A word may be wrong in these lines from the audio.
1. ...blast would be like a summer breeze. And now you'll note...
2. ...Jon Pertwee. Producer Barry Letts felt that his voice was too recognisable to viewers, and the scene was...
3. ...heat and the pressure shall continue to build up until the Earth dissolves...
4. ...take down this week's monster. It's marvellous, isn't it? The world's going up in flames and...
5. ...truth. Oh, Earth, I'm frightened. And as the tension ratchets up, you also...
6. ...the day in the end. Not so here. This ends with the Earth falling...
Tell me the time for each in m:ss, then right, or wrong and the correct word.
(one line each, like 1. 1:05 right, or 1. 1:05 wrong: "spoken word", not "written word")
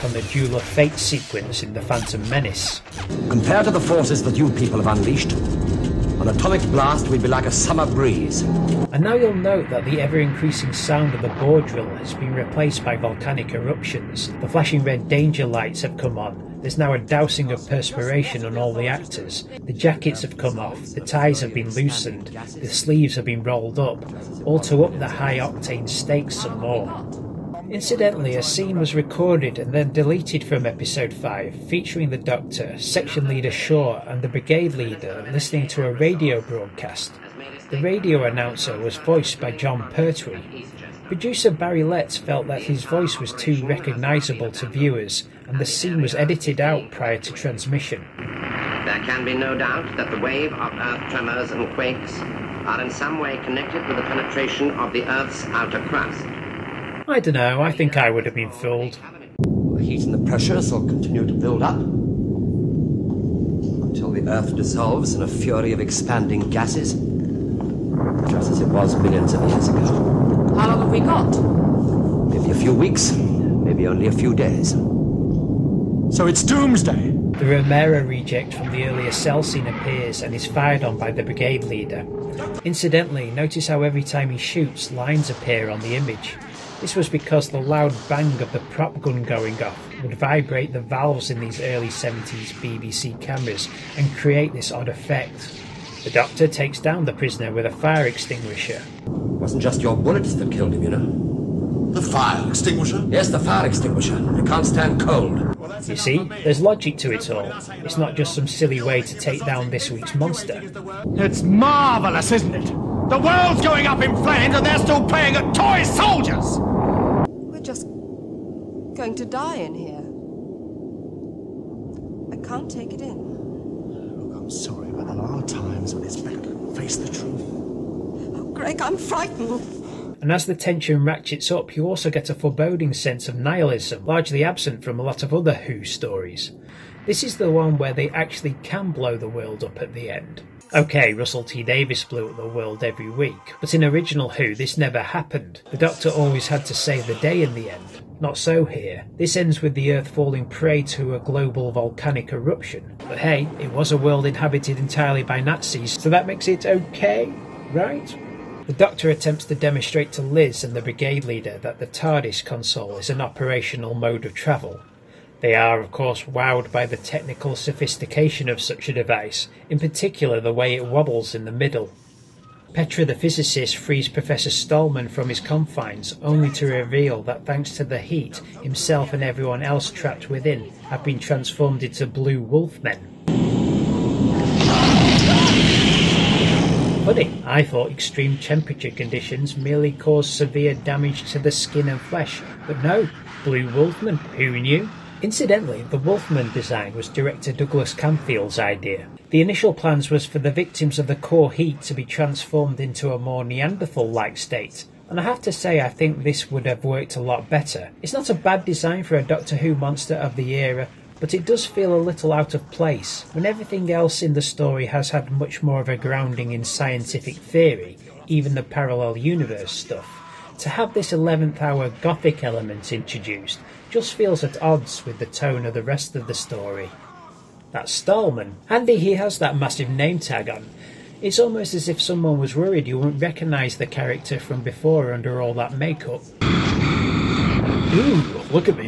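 1. 0:06 right
2. 0:39 right
3. 0:59 right
4. 1:49 right
5. 2:07 wrong: "Greg", not "Earth"
6. 2:27 right.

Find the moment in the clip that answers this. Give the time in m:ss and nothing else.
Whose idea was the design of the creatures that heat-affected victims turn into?
3:17.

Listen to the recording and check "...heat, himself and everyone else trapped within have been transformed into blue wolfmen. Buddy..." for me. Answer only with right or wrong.
right.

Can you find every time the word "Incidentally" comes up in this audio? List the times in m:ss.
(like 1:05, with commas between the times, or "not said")
0:27, 1:22, 3:15.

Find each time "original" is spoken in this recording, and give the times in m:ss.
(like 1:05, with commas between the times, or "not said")
2:23.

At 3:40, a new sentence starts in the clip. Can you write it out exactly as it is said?
To have this 11th hour gothic element introduced just feels at odds with the tone of the rest of the story.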